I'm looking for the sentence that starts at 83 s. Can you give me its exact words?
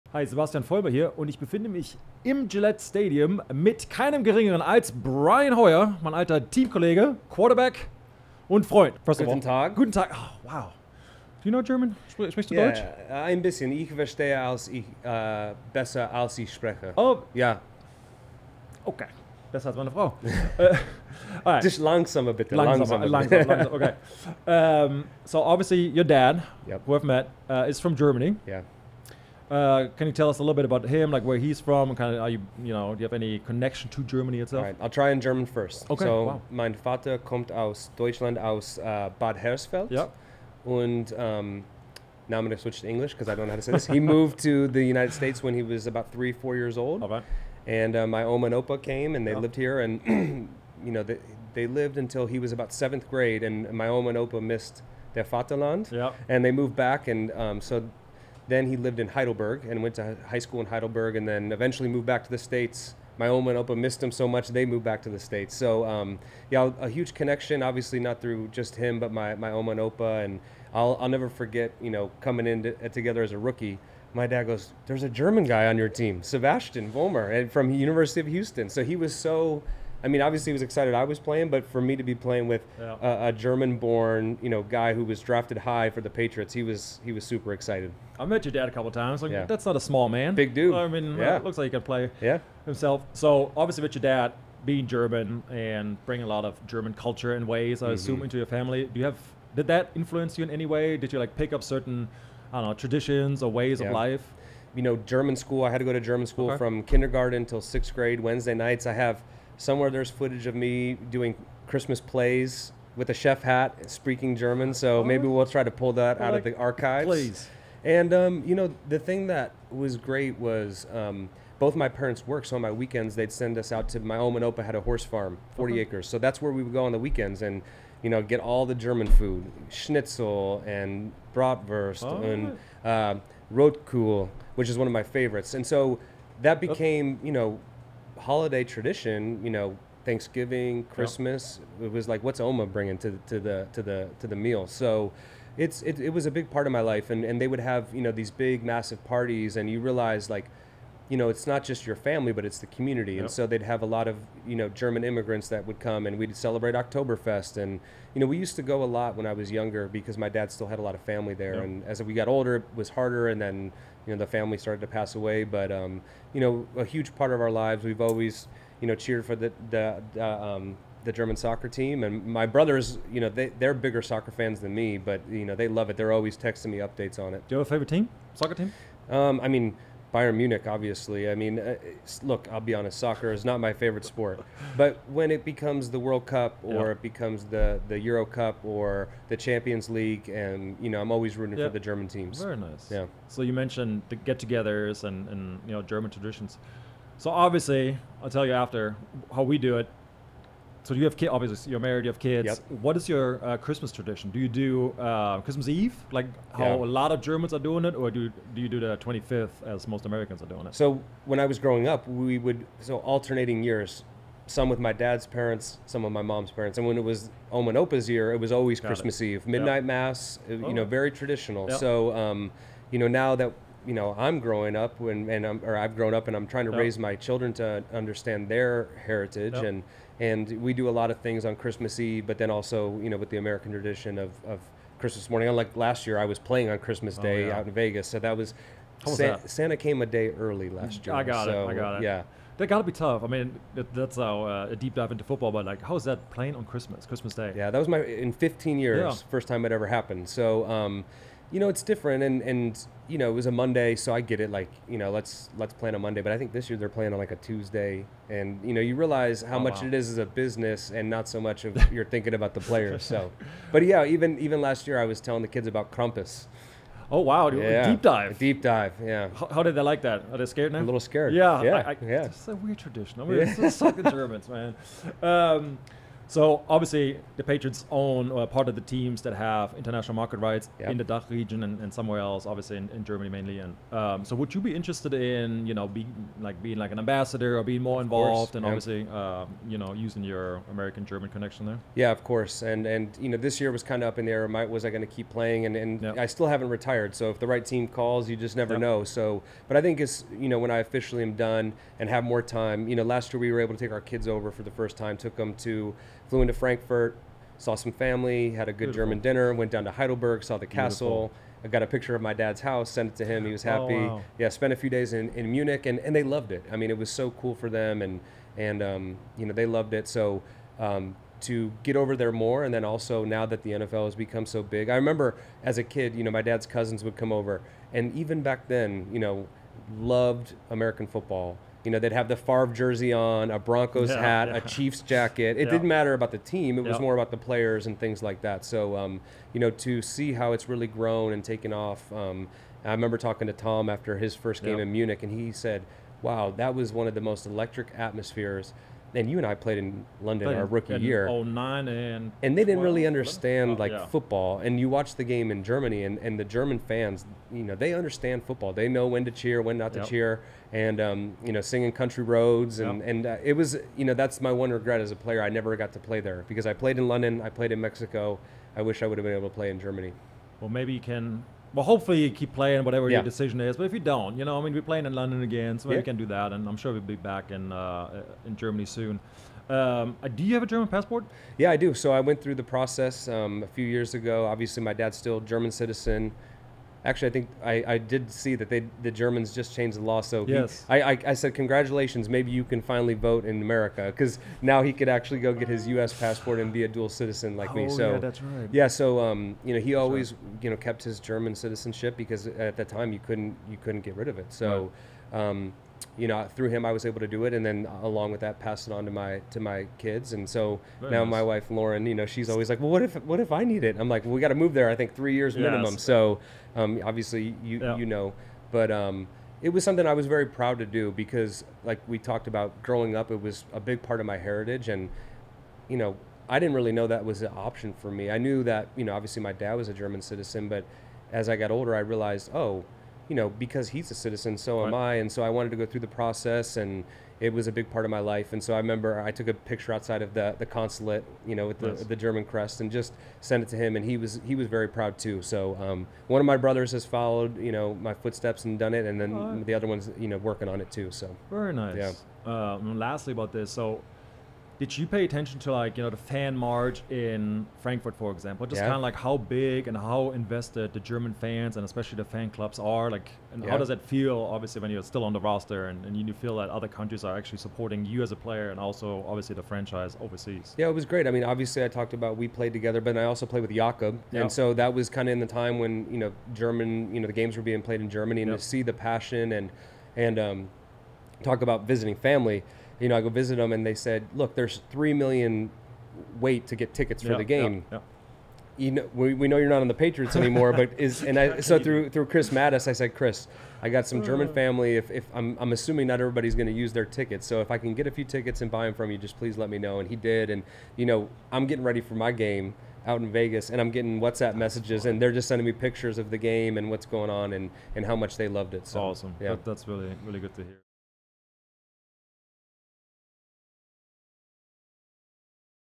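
a, a German-born, you know, guy who was drafted high for the Patriots, he was he was super excited.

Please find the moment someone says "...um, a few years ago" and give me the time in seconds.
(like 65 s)
383 s.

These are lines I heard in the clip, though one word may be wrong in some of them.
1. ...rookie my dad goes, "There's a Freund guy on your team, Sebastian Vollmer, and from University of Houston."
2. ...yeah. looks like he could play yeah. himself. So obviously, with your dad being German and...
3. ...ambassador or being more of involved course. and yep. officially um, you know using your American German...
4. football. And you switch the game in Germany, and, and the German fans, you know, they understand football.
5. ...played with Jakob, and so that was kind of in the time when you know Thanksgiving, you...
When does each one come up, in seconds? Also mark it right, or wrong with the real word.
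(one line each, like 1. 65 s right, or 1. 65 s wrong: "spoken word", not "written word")
1. 73 s wrong: "German", not "Freund"
2. 91 s right
3. 286 s wrong: "obviously", not "officially"
4. 354 s wrong: "watch", not "switch"
5. 473 s wrong: "German", not "Thanksgiving".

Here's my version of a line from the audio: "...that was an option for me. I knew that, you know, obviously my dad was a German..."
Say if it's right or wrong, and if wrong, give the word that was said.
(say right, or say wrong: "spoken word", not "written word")
right.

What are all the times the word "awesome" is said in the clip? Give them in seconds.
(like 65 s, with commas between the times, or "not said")
509 s.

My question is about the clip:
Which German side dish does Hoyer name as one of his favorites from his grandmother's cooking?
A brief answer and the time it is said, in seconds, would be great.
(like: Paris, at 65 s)
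Rotkohl, at 133 s.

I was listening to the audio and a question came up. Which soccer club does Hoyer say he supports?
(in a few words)
Bayern Munich.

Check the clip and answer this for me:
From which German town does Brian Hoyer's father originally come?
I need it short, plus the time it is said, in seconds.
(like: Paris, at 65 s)
Bad Hersfeld, at 39 s.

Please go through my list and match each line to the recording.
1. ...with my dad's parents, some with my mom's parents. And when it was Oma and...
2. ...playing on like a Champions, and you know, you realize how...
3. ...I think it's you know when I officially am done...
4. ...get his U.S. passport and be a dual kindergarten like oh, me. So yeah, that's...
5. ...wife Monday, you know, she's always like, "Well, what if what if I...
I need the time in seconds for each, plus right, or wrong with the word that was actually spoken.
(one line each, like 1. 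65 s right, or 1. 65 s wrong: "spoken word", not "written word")
1. 214 s right
2. 256 s wrong: "Tuesday", not "Champions"
3. 299 s right
4. 395 s wrong: "citizen", not "kindergarten"
5. 411 s wrong: "Lauren", not "Monday".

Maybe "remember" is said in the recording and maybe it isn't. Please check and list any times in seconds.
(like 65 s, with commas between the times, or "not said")
324 s, 342 s, 438 s.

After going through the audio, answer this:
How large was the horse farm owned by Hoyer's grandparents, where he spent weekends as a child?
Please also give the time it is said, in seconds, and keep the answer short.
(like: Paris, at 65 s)
40 acres, at 125 s.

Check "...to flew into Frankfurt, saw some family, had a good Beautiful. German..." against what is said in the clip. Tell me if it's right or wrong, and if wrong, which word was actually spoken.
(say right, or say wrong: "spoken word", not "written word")
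right.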